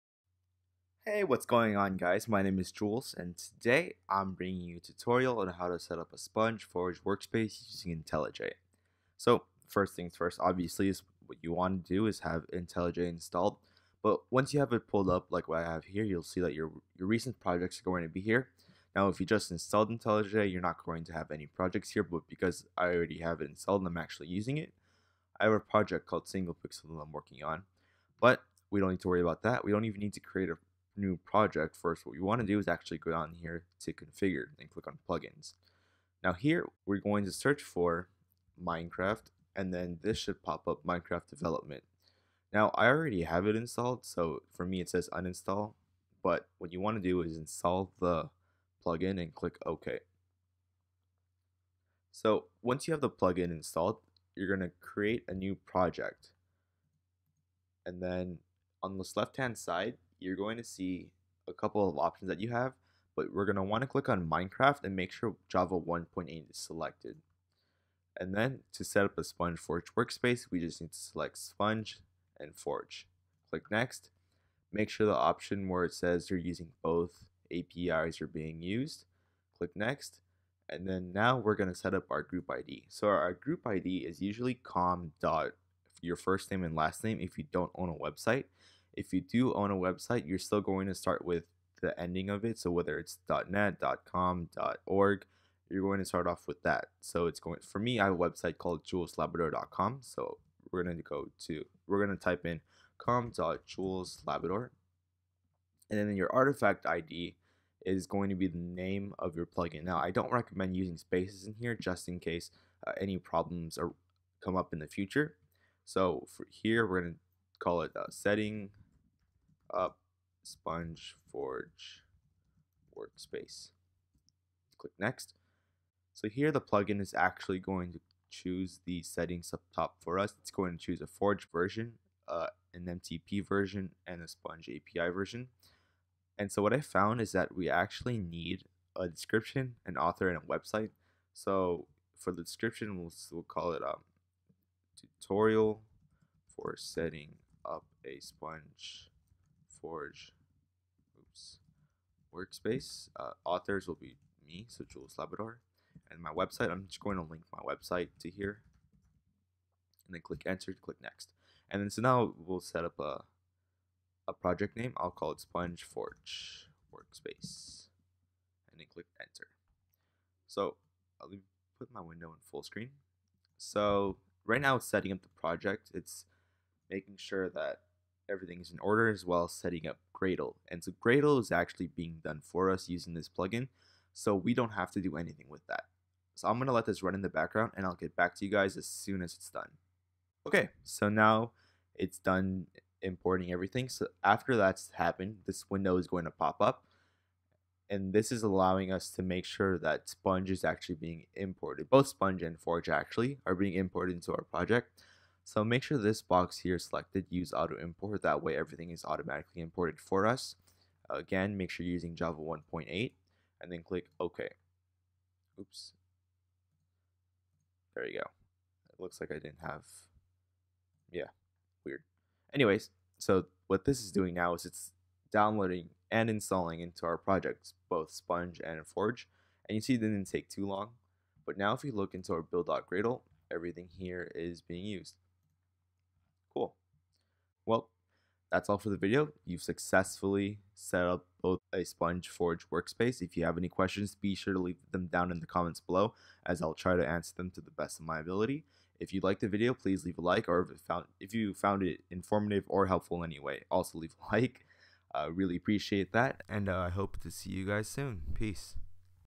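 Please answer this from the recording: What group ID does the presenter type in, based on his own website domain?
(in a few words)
com.juleslabador.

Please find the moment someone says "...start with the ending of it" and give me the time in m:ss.
1:30.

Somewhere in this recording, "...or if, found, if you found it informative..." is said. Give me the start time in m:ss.
4:10.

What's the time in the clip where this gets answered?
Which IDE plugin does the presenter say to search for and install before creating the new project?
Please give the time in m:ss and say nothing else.
0:40.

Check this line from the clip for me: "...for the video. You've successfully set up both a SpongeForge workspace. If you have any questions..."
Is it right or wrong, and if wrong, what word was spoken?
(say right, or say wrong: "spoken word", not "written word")
right.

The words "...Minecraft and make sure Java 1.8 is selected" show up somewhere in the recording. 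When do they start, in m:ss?
1:04.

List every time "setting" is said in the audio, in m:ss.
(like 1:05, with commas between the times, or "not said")
1:58, 2:09, 2:26, 2:54, 2:59.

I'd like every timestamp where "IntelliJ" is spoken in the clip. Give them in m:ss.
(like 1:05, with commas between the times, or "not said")
0:08, 0:12, 0:19.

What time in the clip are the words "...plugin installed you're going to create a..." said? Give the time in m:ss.
0:53.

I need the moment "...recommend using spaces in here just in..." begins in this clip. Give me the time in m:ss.
1:50.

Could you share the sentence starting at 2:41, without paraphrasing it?
And then so now we'll set up a, a project name.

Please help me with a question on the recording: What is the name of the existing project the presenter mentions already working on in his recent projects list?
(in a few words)
Single Pixel.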